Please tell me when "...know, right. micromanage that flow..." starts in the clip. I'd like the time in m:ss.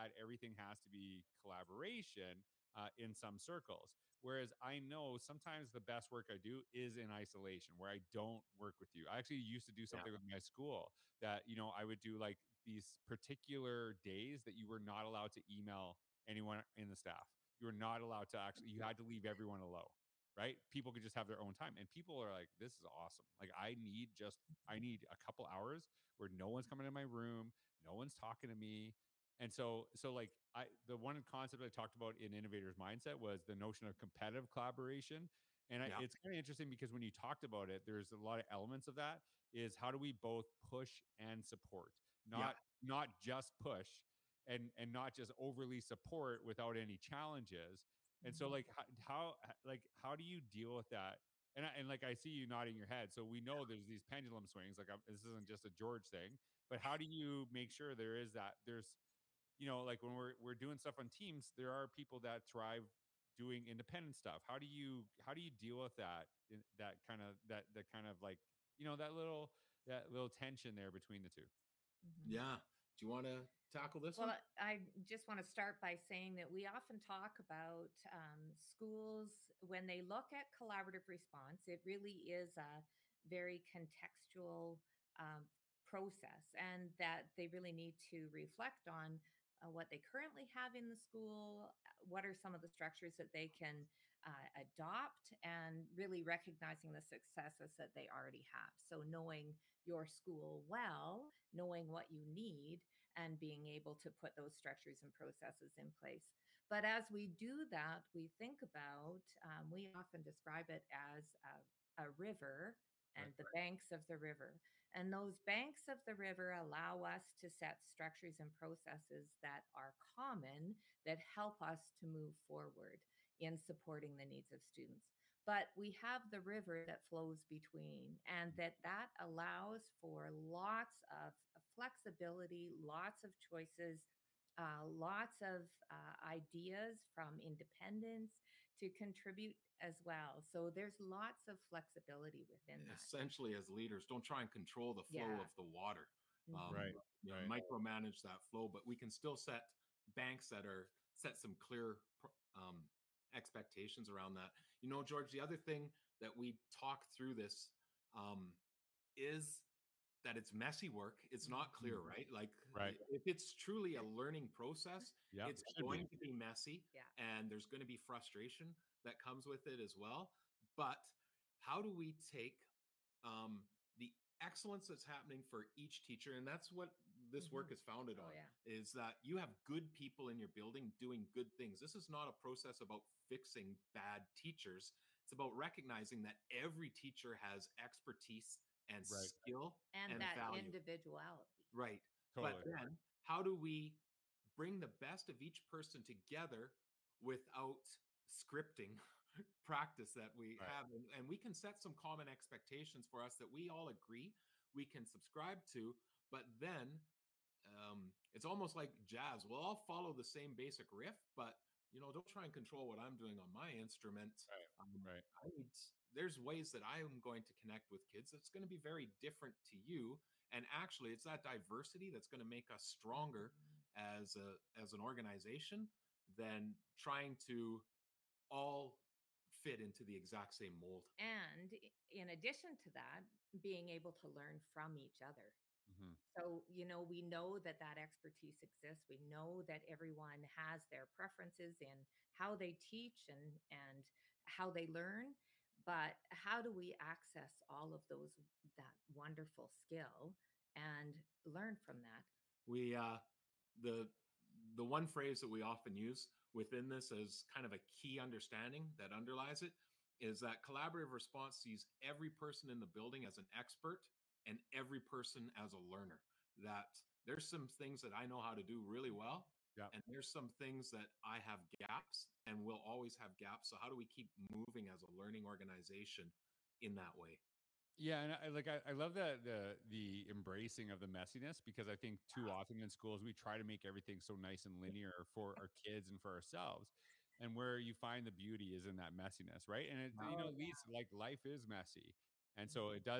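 2:27.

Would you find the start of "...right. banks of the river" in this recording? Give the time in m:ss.
1:53.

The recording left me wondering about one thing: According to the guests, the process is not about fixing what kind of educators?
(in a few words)
bad teachers.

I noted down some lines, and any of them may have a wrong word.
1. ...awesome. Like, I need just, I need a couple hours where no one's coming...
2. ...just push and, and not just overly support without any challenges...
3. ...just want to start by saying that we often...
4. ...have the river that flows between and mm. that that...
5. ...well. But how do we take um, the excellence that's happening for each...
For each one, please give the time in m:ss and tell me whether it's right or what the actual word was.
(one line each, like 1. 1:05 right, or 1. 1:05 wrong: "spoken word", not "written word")
1. 0:22 right
2. 0:43 right
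3. 1:15 right
4. 2:05 right
5. 2:49 right.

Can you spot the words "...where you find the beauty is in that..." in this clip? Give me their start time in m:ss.
4:47.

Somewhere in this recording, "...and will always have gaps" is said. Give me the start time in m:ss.
4:32.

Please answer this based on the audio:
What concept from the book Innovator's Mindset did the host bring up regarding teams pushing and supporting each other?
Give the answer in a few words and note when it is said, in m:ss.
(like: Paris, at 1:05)
competitive collaboration, at 0:33.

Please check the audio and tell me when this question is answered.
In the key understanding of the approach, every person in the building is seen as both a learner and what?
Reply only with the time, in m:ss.
4:23.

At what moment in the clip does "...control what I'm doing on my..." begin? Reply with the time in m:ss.
3:32.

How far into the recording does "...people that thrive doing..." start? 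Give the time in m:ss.
1:01.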